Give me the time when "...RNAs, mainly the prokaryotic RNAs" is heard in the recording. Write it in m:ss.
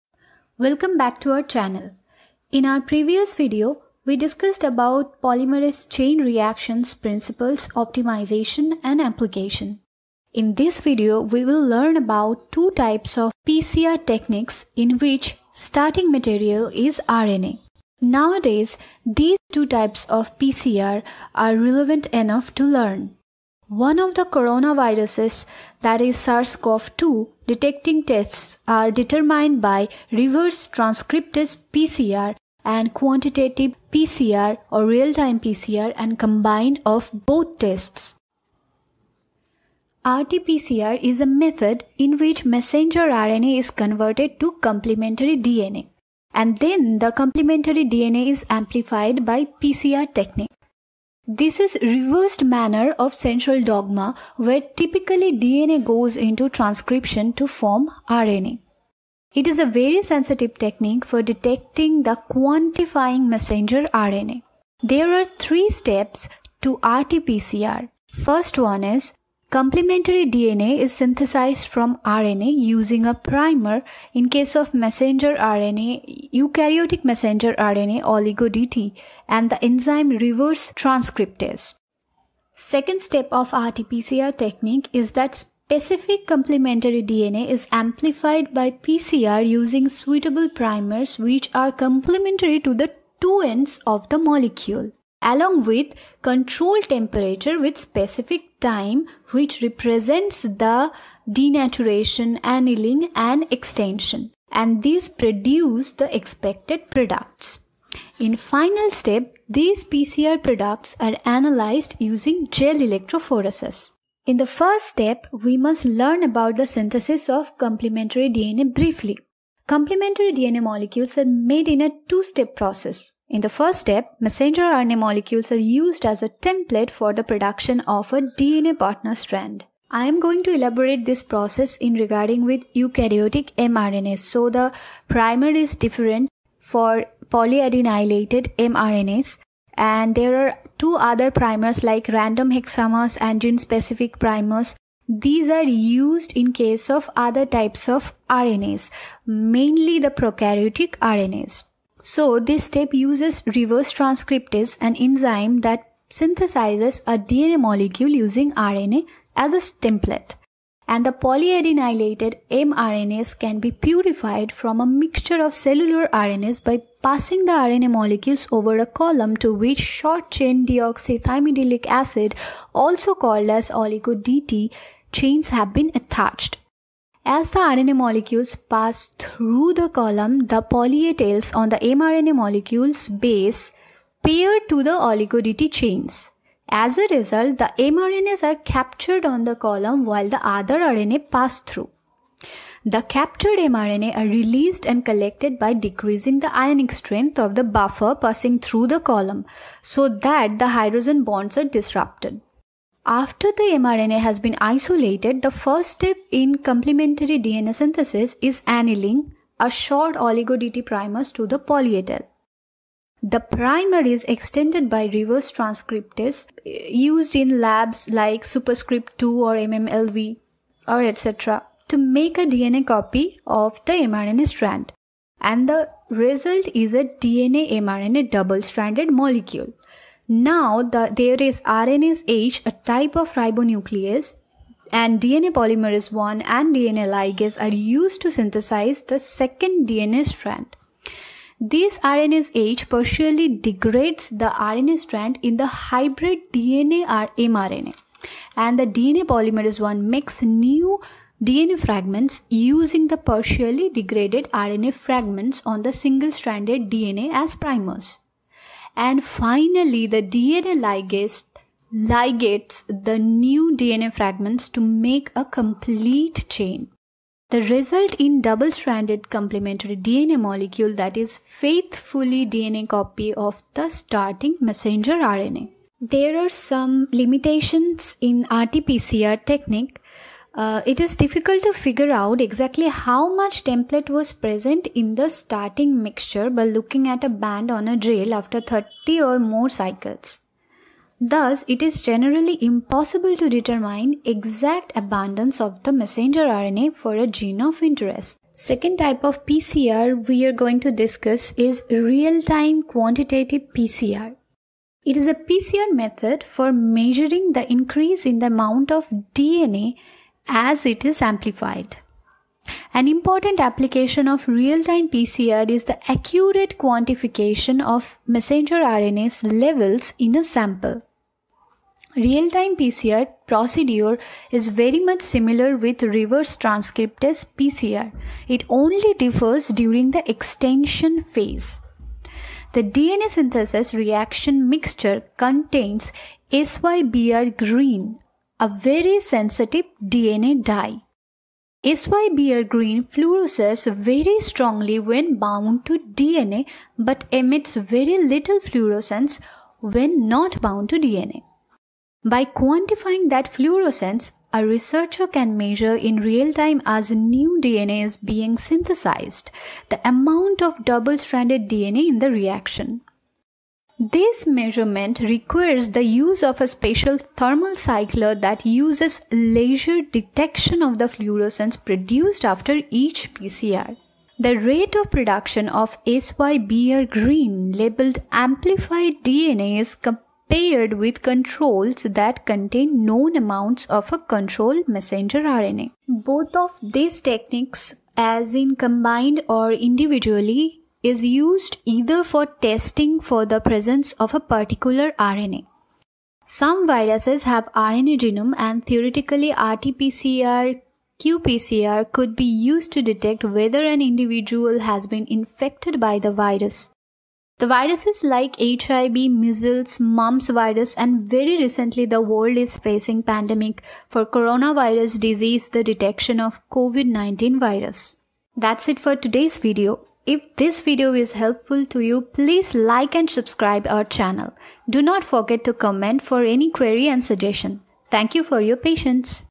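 2:28.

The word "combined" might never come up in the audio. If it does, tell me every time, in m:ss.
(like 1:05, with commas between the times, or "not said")
0:36, 6:28.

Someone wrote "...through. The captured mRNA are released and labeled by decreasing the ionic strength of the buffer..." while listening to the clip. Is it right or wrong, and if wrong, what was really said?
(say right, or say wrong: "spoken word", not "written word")
wrong: "collected", not "labeled".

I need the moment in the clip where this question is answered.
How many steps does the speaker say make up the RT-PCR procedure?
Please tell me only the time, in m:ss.
1:05.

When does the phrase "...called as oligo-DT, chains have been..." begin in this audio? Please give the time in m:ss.
2:53.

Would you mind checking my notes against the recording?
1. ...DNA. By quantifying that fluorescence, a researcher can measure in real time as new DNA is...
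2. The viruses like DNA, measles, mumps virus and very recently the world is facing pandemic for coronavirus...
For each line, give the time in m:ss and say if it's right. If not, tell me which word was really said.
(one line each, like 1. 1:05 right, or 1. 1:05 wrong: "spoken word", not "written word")
1. 5:50 right
2. 6:47 wrong: "HIV", not "DNA".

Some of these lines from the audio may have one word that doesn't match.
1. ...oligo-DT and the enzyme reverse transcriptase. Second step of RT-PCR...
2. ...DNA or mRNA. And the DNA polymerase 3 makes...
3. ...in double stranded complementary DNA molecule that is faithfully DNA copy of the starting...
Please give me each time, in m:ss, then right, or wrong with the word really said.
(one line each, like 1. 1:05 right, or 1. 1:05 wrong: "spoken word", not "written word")
1. 1:18 right
2. 4:06 wrong: "1", not "3"
3. 4:28 right.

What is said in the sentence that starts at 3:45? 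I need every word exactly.
And the result is a DNA mRNA double-stranded molecule.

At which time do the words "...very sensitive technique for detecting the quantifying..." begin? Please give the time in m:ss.
0:59.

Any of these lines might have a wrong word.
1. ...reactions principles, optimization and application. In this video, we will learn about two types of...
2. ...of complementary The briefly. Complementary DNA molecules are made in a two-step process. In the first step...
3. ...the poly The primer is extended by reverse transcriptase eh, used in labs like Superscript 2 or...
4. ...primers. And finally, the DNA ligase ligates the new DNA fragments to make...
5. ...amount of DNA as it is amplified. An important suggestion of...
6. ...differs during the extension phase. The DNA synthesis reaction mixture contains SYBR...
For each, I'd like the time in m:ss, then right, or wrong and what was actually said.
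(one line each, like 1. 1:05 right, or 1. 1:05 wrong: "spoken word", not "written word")
1. 0:06 right
2. 1:57 wrong: "DNA", not "The"
3. 3:31 right
4. 4:17 right
5. 5:08 wrong: "application", not "suggestion"
6. 5:29 right.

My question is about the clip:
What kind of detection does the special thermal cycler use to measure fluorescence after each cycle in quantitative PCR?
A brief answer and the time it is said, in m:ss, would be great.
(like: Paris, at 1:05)
Laser detection, at 6:09.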